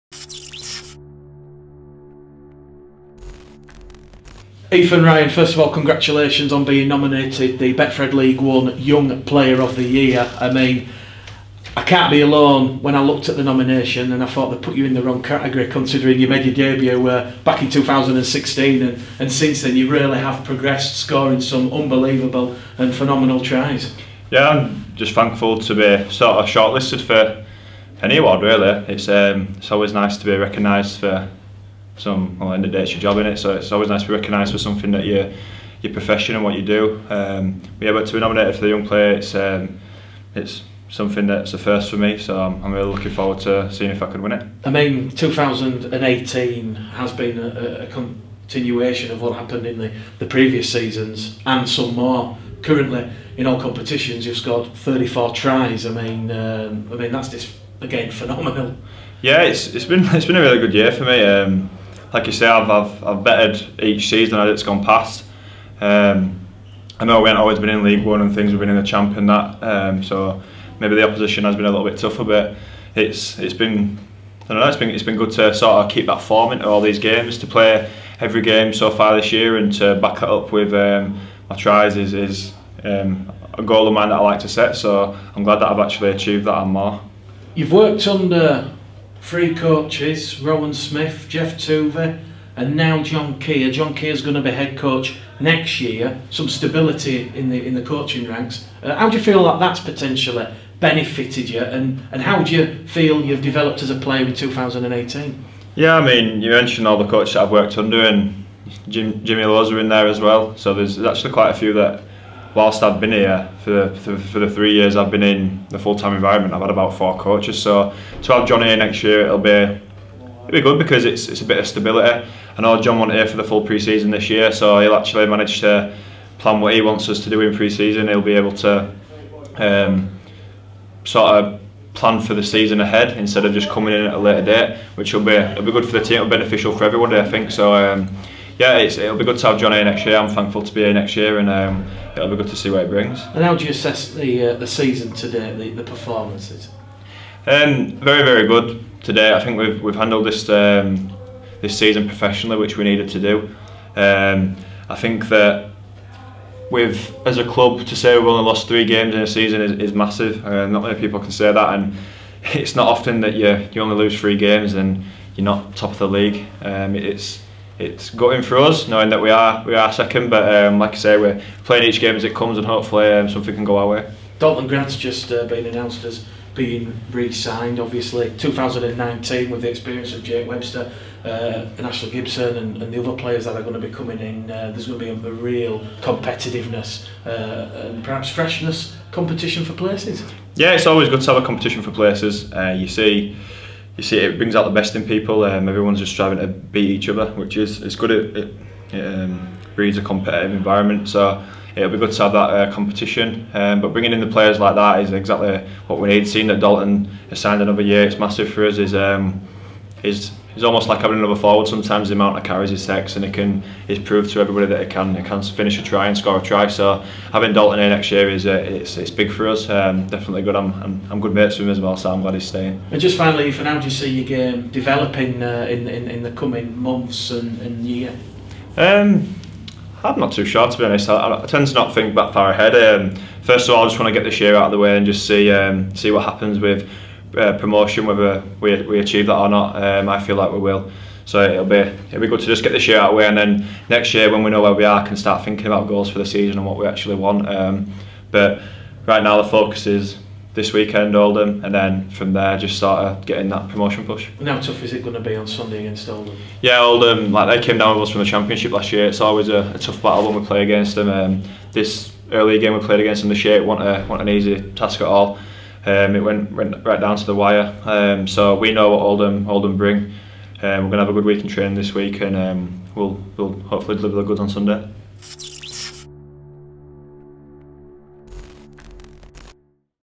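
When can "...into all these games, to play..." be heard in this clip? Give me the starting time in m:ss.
1:16.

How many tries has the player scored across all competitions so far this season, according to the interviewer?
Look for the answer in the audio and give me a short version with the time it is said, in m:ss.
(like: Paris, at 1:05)
34, at 0:54.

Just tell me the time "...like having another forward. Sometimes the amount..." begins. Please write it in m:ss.
3:30.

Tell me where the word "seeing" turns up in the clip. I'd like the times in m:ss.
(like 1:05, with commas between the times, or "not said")
0:43, 3:26.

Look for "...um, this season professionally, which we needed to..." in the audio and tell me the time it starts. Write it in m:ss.
2:30.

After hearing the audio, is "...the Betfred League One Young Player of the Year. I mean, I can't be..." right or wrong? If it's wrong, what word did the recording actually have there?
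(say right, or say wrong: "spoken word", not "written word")
right.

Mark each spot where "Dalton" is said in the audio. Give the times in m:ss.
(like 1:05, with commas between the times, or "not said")
2:54, 3:26, 3:37.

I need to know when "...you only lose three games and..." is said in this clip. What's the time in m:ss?
2:43.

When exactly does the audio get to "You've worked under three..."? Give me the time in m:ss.
1:27.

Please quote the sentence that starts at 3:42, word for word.
And just finally, Ethan, how do you see your um, game developing uh, in, in in the coming months and, and year?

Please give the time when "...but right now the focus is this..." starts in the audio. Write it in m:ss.
4:08.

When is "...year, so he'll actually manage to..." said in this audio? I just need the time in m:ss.
2:04.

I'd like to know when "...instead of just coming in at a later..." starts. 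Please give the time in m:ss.
2:13.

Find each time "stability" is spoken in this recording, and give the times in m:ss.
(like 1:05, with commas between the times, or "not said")
1:36, 2:01.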